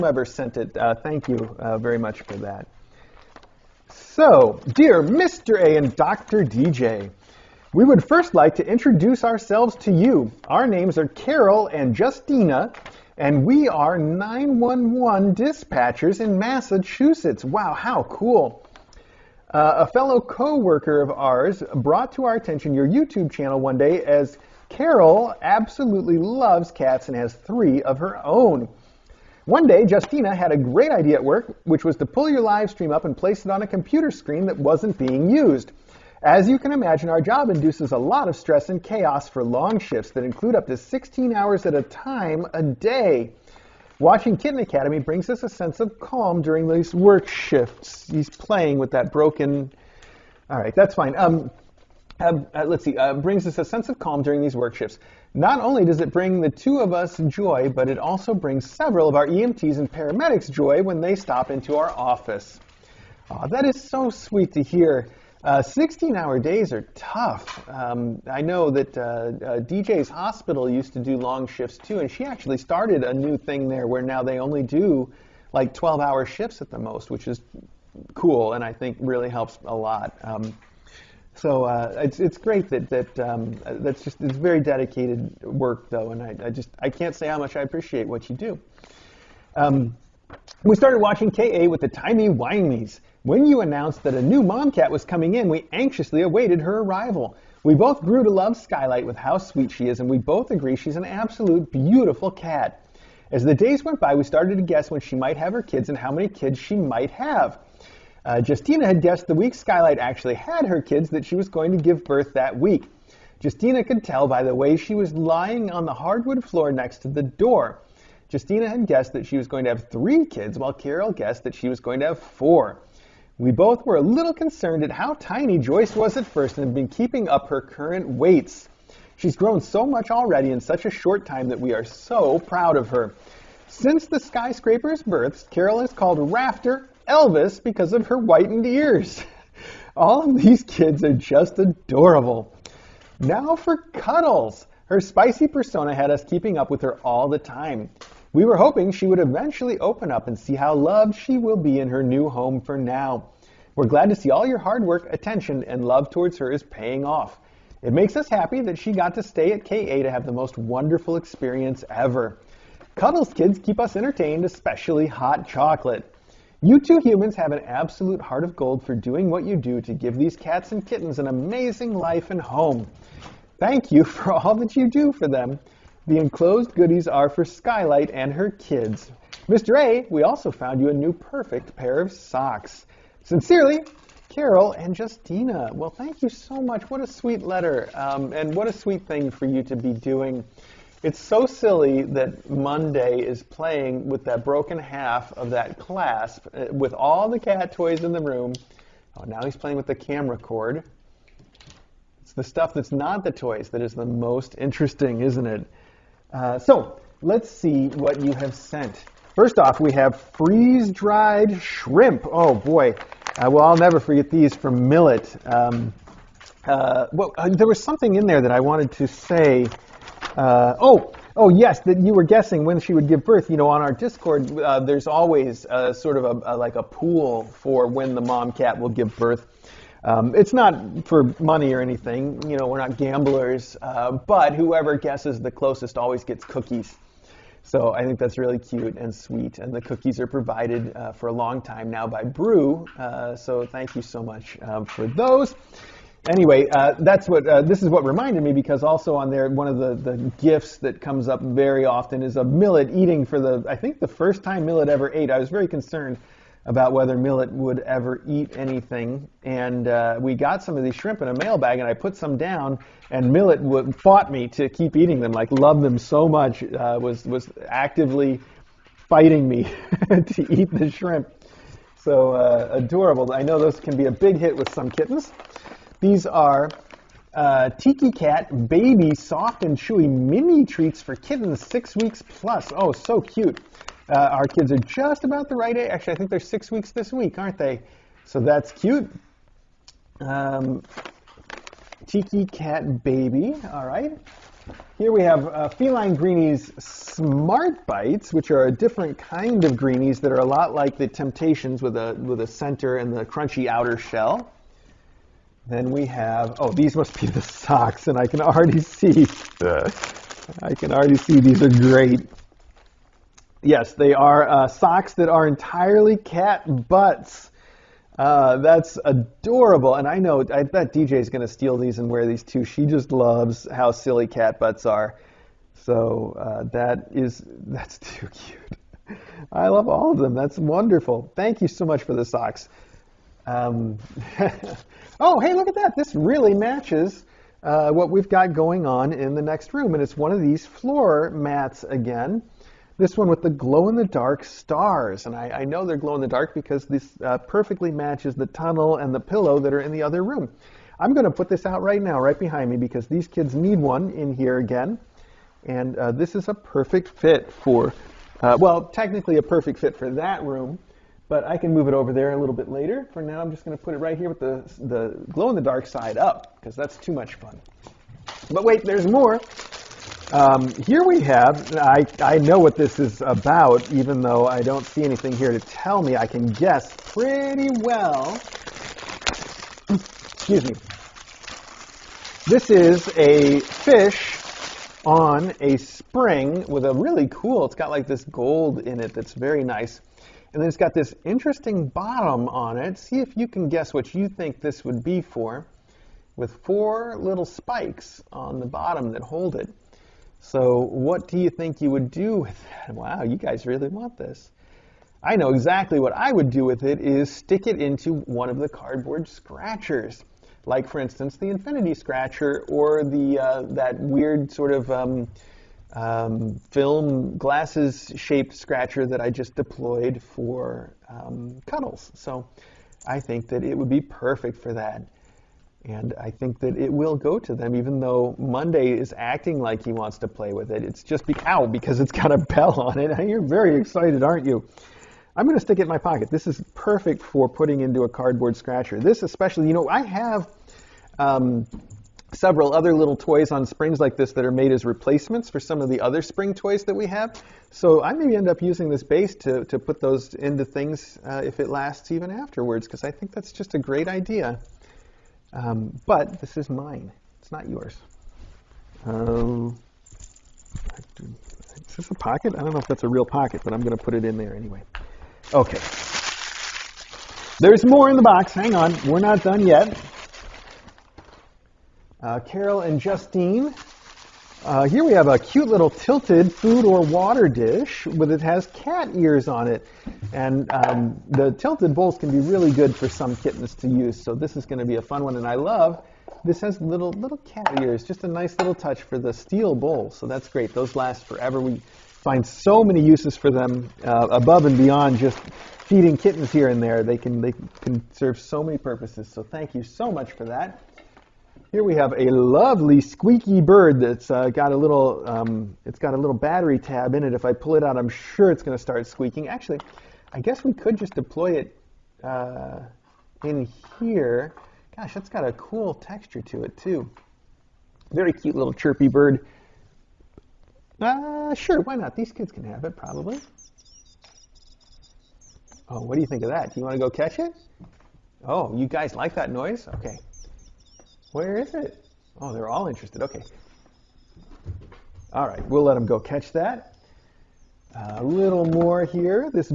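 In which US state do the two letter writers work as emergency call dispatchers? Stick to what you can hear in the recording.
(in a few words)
Massachusetts.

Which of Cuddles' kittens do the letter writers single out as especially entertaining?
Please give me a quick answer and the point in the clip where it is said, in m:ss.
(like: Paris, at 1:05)
Hot Chocolate, at 2:45.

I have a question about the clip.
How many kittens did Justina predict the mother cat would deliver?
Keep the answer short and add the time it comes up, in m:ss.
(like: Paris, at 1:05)
3, at 1:59.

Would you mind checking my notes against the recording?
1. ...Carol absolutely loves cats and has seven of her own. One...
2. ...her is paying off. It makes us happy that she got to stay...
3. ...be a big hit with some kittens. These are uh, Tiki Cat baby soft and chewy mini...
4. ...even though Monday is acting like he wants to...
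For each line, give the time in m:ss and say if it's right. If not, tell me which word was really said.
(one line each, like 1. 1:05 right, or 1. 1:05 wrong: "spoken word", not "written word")
1. 0:24 wrong: "three", not "seven"
2. 2:36 right
3. 4:33 right
4. 7:07 right.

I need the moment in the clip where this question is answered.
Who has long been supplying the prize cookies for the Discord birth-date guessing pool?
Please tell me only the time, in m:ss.
4:02.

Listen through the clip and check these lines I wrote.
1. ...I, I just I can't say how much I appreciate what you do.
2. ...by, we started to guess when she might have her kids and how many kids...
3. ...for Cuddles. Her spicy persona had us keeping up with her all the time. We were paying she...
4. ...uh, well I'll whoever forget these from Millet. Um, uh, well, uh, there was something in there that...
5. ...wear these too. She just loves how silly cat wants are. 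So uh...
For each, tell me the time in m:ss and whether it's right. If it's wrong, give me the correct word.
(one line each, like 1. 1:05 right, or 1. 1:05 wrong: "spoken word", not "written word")
1. 1:26 right
2. 1:44 right
3. 2:23 wrong: "hoping", not "paying"
4. 3:33 wrong: "never", not "whoever"
5. 5:22 wrong: "butts", not "wants".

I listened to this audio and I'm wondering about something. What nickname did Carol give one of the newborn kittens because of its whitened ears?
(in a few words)
Rafter Elvis.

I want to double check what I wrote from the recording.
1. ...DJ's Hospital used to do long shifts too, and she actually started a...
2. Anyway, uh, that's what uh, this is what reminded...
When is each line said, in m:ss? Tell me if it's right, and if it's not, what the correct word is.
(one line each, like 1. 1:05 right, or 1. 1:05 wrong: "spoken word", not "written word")
1. 1:09 right
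2. 4:06 right.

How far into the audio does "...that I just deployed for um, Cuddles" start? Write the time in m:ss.
6:59.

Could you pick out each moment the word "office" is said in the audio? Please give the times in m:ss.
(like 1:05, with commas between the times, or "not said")
1:01.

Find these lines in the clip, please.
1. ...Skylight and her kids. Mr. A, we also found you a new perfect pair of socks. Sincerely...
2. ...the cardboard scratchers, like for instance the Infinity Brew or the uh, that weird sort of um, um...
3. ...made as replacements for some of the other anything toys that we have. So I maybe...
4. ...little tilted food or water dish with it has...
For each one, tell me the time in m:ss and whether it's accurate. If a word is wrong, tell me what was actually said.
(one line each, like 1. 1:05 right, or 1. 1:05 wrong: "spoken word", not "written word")
1. 2:57 right
2. 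6:48 wrong: "Scratcher", not "Brew"
3. 7:24 wrong: "spring", not "anything"
4. 7:55 right.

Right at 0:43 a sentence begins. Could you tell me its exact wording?
Watching Kitten Academy brings us a sense of calm during these work shifts.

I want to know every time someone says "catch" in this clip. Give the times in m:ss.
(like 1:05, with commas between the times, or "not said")
8:47, 8:56.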